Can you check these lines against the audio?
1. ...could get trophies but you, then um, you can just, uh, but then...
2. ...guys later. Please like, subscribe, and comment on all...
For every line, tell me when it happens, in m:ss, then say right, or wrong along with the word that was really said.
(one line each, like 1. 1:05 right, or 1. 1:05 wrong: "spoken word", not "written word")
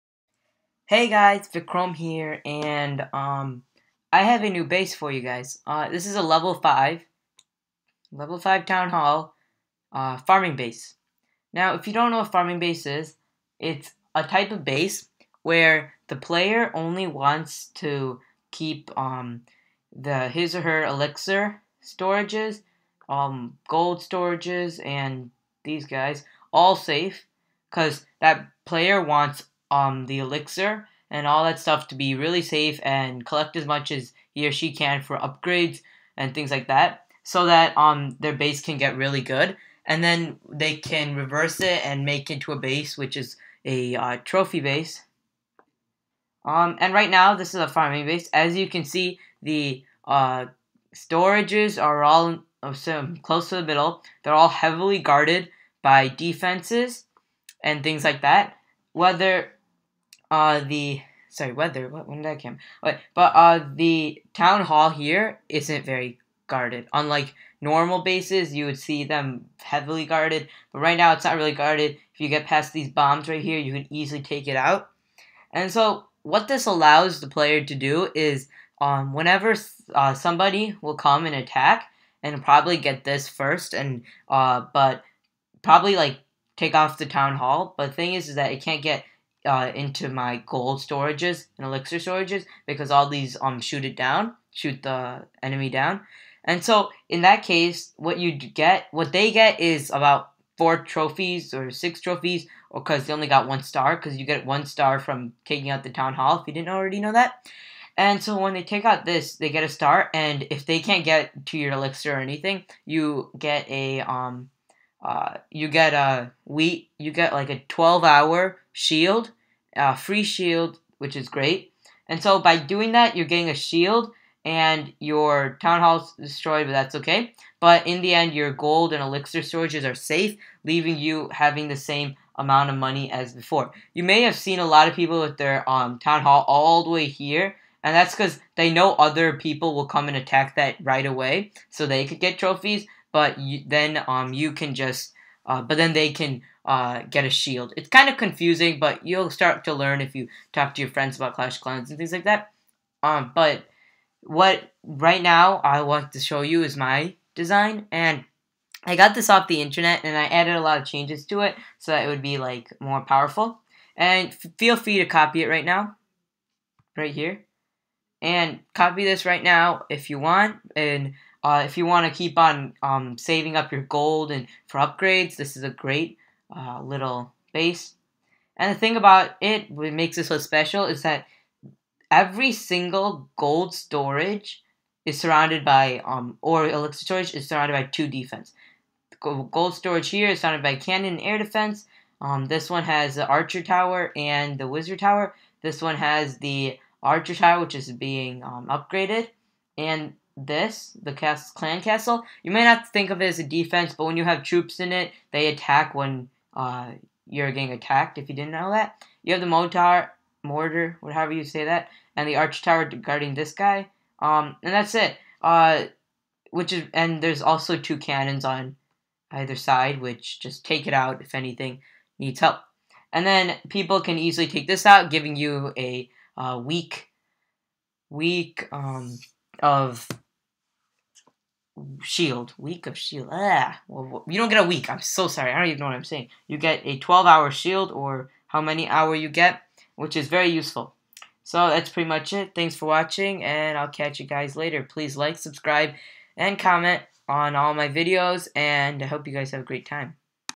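1. 2:22 right
2. 4:04 right.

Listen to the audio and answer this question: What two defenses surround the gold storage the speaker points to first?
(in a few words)
Cannon and air defense.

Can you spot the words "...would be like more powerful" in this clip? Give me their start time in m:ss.
2:42.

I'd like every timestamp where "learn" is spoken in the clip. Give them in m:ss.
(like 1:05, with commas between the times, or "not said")
2:29.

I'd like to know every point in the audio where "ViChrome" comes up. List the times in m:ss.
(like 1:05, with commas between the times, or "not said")
0:01.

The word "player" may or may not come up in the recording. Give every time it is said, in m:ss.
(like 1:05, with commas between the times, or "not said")
0:16, 0:28, 1:17.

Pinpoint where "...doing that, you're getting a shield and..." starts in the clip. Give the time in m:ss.
2:02.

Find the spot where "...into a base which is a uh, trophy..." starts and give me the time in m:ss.
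0:42.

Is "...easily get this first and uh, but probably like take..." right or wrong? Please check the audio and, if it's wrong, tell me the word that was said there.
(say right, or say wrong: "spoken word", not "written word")
wrong: "probably", not "easily".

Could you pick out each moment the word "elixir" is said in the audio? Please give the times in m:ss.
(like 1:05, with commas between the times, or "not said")
0:20, 0:30, 1:31, 1:51, 2:09, 3:06.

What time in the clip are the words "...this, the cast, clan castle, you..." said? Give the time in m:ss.
3:20.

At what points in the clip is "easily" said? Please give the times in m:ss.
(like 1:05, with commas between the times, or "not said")
1:13, 3:44.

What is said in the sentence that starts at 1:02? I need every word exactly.
Wait, but uh, the town hall here isn't very guarded.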